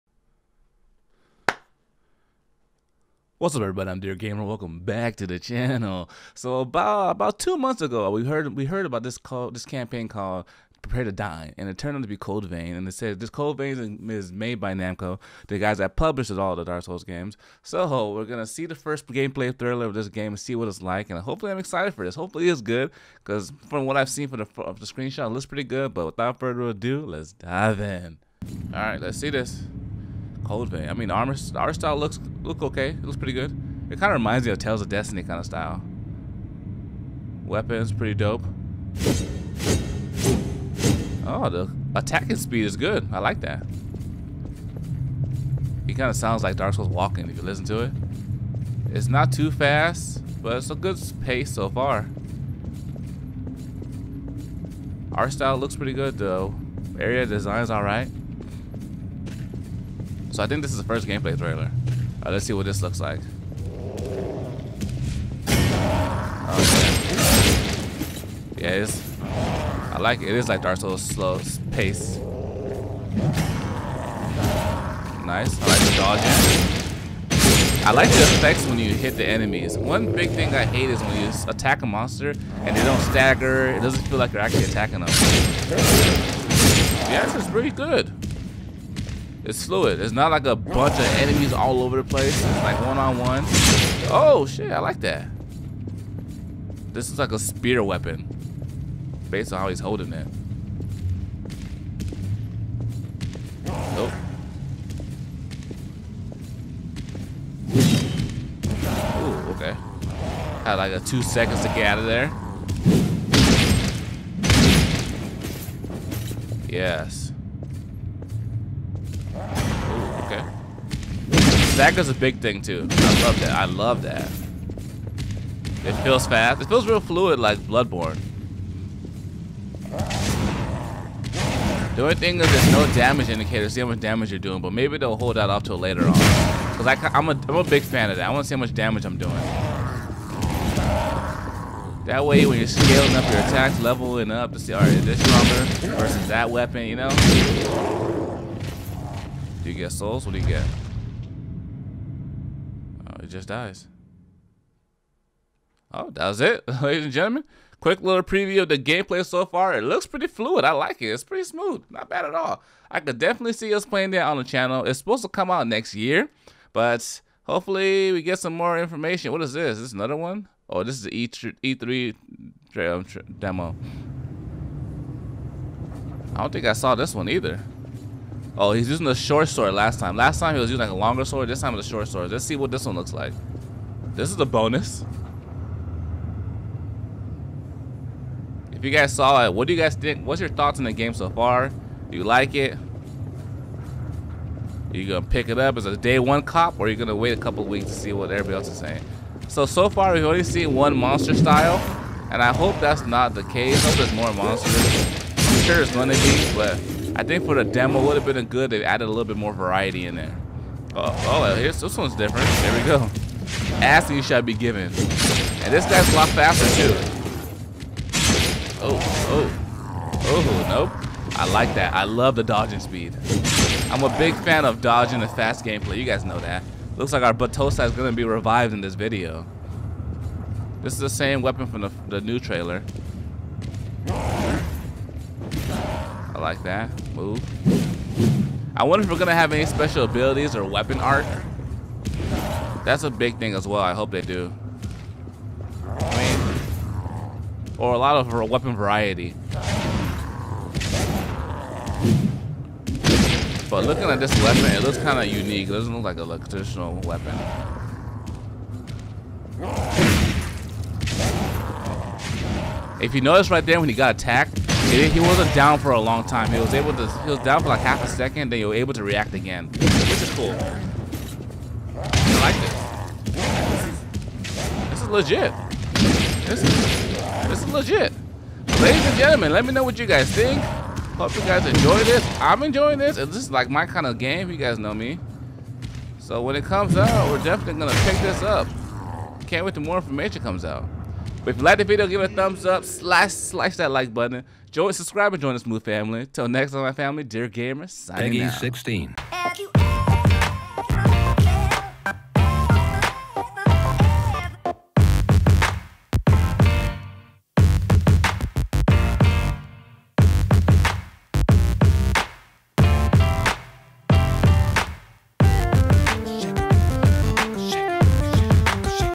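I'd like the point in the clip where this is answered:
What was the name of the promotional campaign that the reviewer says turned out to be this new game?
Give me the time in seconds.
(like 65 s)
10 s.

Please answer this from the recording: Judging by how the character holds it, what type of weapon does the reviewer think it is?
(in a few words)
Spear.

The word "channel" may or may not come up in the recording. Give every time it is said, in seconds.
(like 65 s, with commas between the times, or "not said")
5 s, 164 s.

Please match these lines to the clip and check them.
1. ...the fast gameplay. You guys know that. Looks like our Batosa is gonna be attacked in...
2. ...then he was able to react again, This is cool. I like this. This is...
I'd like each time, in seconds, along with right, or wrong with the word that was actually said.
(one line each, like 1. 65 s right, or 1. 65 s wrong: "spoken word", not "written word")
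1. 225 s wrong: "revived", not "attacked"
2. 268 s right.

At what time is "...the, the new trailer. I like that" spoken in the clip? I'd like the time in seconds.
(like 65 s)
231 s.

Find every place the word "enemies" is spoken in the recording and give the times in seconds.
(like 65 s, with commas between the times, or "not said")
79 s, 91 s.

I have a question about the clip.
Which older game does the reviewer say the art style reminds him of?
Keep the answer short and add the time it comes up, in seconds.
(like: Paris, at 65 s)
Tales of Destiny, at 34 s.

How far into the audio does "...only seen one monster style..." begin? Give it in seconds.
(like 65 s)
200 s.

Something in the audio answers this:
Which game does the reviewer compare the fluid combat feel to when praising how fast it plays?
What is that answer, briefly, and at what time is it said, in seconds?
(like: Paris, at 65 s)
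Bloodborne, at 127 s.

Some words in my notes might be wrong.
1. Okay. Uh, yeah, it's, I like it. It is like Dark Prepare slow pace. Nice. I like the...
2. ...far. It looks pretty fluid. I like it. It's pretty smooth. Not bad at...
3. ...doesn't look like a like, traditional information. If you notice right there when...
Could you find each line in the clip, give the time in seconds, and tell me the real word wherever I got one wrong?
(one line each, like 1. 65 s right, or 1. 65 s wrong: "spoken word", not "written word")
1. 63 s wrong: "Souls", not "Prepare"
2. 159 s right
3. 255 s wrong: "weapon", not "information".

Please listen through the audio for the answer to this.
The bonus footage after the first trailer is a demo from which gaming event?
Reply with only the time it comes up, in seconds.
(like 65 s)
171 s.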